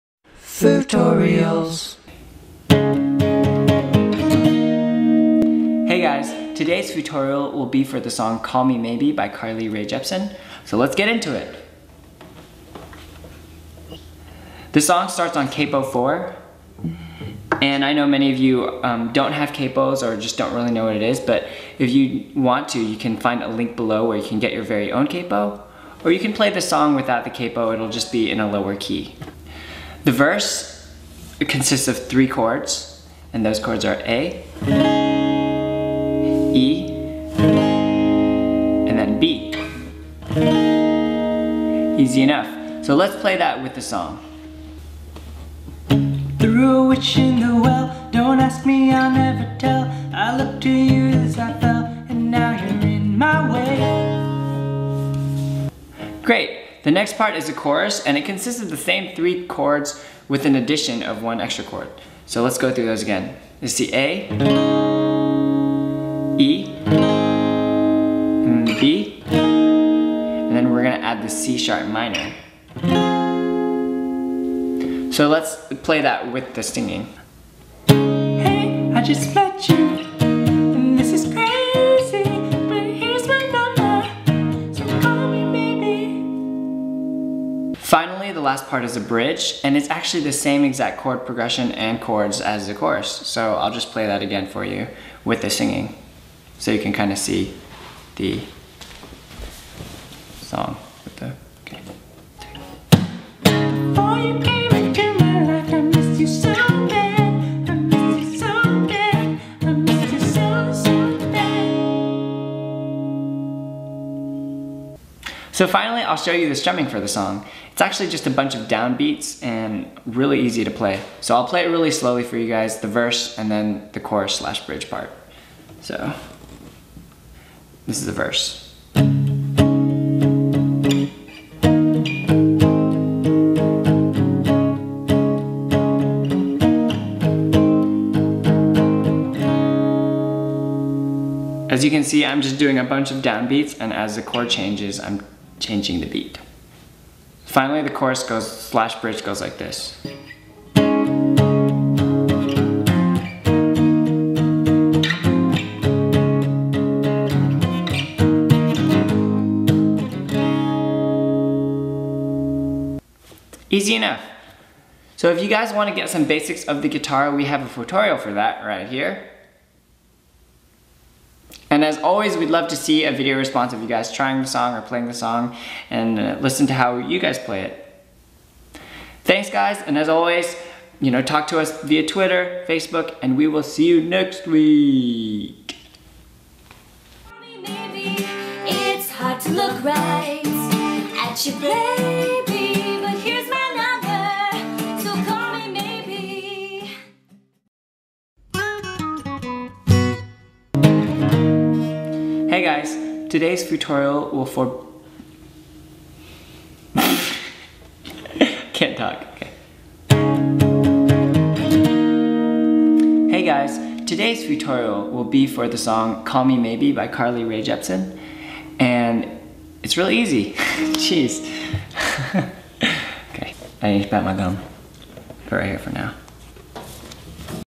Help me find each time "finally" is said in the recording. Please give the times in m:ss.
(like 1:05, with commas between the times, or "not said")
1:27, 1:55, 2:27.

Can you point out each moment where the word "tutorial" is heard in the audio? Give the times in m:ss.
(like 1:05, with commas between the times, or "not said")
0:06, 2:47, 3:23, 3:34.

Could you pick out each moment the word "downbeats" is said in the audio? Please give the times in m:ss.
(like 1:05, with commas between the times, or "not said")
1:58, 2:23.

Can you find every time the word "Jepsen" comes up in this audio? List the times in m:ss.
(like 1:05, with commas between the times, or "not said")
0:09, 3:37.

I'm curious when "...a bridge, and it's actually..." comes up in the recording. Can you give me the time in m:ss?
1:28.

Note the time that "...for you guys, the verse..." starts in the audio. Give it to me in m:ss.
2:02.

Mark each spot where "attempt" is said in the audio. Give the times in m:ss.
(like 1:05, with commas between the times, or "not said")
not said.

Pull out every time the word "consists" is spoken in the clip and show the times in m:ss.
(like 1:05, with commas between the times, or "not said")
0:31, 0:58.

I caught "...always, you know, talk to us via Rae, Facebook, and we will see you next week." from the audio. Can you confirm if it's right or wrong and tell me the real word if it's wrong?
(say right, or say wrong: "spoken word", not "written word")
wrong: "Twitter", not "Rae".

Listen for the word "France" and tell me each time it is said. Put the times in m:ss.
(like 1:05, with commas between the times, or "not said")
not said.